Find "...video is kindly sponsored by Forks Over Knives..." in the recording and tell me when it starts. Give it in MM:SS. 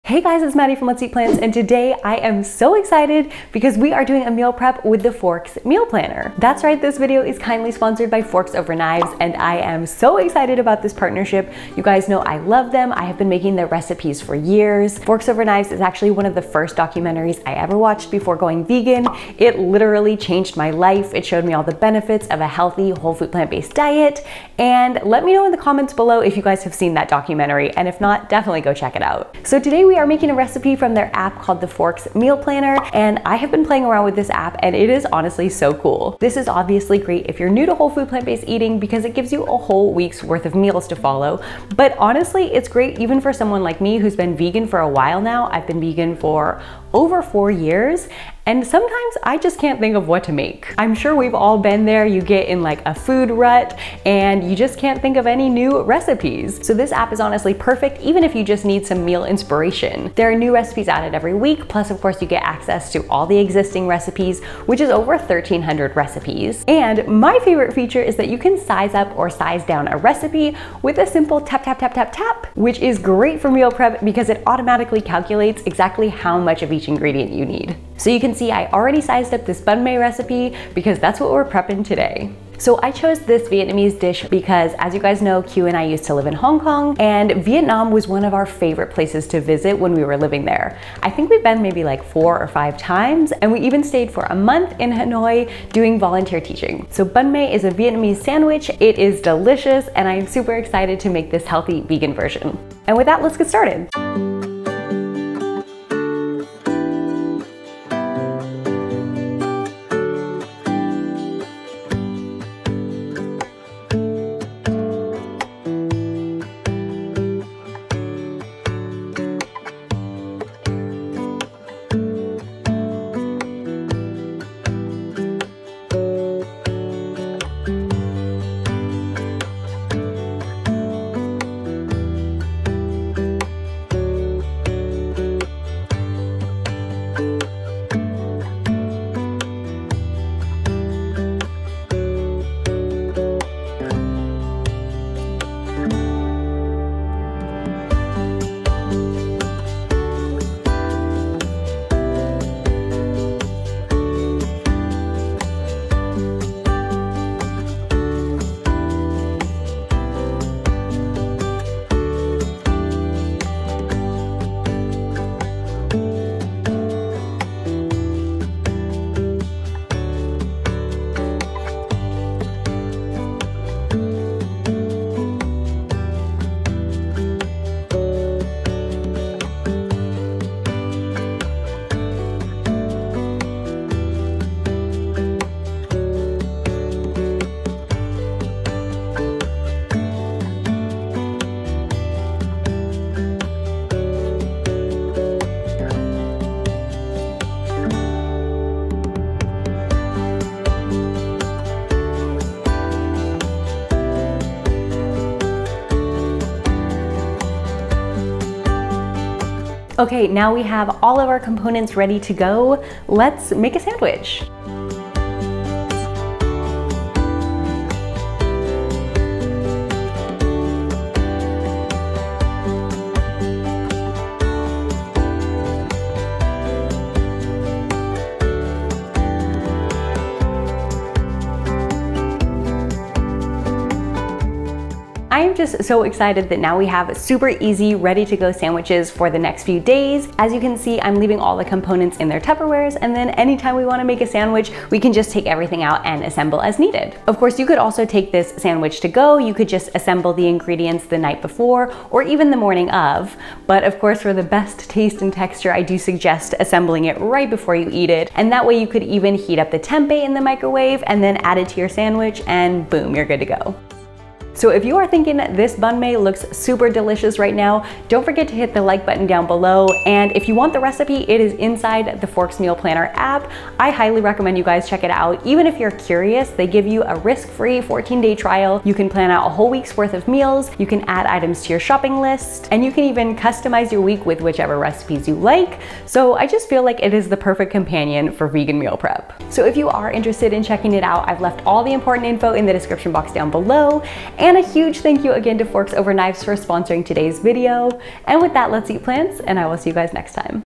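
00:06.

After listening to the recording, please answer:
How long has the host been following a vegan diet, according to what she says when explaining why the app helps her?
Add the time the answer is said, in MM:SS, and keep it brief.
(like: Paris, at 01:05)
over 4 years, at 00:46.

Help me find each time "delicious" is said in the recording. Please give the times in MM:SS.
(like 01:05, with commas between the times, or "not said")
01:39, 04:26.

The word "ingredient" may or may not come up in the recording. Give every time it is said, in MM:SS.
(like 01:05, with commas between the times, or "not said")
01:16, 04:10.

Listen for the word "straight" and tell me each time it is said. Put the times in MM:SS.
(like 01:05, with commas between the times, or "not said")
not said.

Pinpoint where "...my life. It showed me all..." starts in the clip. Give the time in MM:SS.
00:20.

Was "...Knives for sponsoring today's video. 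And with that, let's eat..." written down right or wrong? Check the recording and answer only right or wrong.
right.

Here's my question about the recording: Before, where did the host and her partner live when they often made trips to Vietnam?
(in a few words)
Hong Kong.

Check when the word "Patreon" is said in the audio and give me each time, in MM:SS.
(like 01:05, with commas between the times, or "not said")
not said.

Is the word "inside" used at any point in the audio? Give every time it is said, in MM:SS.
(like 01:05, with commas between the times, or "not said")
04:31.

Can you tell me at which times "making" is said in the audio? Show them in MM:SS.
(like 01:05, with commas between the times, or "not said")
00:13, 00:30.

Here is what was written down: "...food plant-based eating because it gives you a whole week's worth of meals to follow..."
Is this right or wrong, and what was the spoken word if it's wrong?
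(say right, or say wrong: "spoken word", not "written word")
right.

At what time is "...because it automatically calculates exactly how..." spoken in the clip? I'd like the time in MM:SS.
01:14.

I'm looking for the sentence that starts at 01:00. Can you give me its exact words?
There are new recipes added every week.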